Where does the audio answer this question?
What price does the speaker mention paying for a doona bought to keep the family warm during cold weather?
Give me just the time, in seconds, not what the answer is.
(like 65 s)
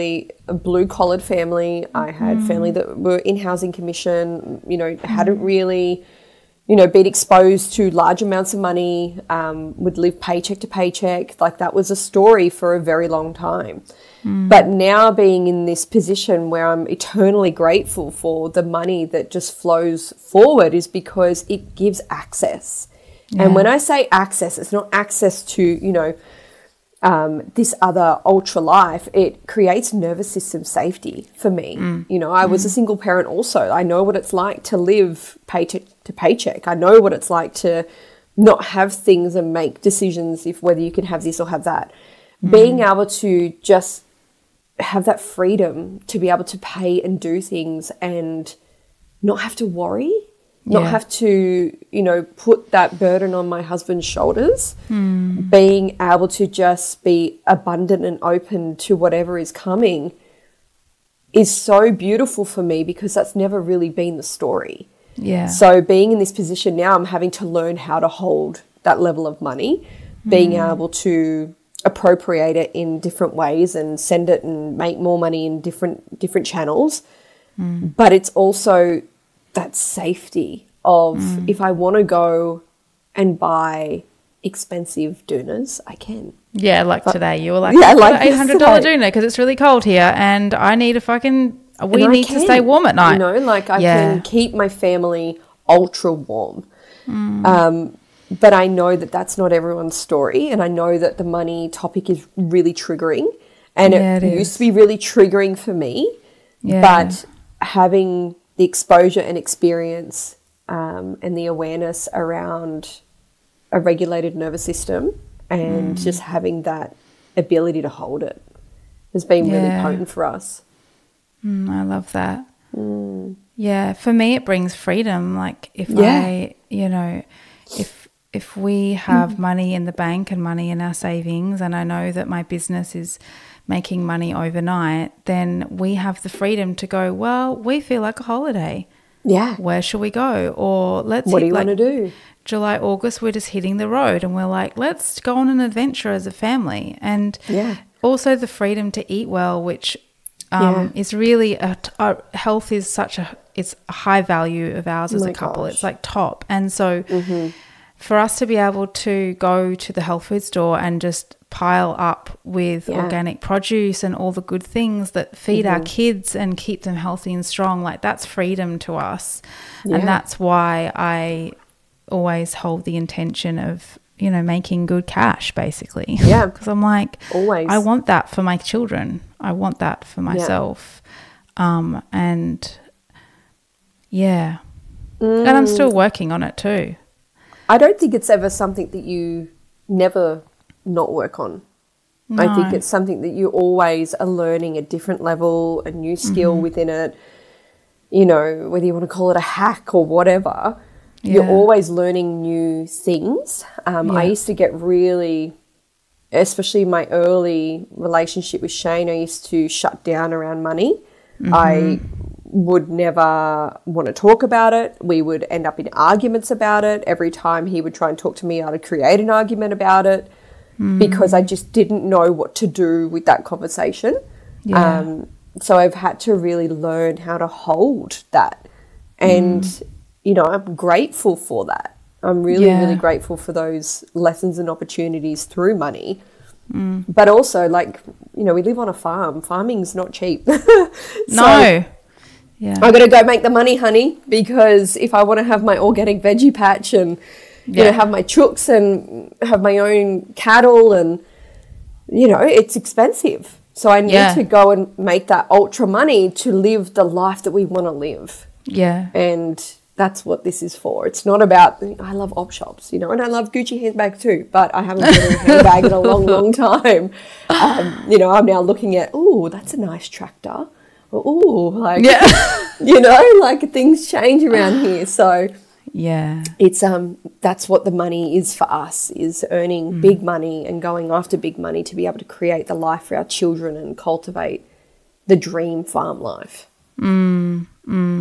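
88 s.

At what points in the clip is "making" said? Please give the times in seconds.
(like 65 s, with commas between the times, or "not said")
133 s, 174 s.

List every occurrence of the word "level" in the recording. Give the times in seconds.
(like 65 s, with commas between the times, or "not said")
68 s, 195 s.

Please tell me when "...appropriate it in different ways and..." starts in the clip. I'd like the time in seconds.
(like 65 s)
71 s.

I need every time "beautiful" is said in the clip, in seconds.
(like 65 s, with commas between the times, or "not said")
61 s.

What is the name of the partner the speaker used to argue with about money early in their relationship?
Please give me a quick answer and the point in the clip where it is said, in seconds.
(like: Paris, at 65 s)
Shane, at 208 s.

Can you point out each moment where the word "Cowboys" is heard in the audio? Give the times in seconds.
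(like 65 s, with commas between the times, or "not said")
not said.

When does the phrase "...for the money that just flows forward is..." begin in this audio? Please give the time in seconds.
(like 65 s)
18 s.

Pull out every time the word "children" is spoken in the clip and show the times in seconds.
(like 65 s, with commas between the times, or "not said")
178 s, 283 s.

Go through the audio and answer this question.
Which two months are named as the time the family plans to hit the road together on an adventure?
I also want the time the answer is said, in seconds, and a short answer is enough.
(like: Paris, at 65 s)
July, August, at 142 s.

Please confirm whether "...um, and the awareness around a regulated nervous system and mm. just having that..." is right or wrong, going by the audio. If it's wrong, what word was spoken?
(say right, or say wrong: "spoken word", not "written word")
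right.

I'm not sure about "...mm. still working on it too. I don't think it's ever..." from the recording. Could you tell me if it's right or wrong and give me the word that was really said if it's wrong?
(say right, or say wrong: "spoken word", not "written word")
right.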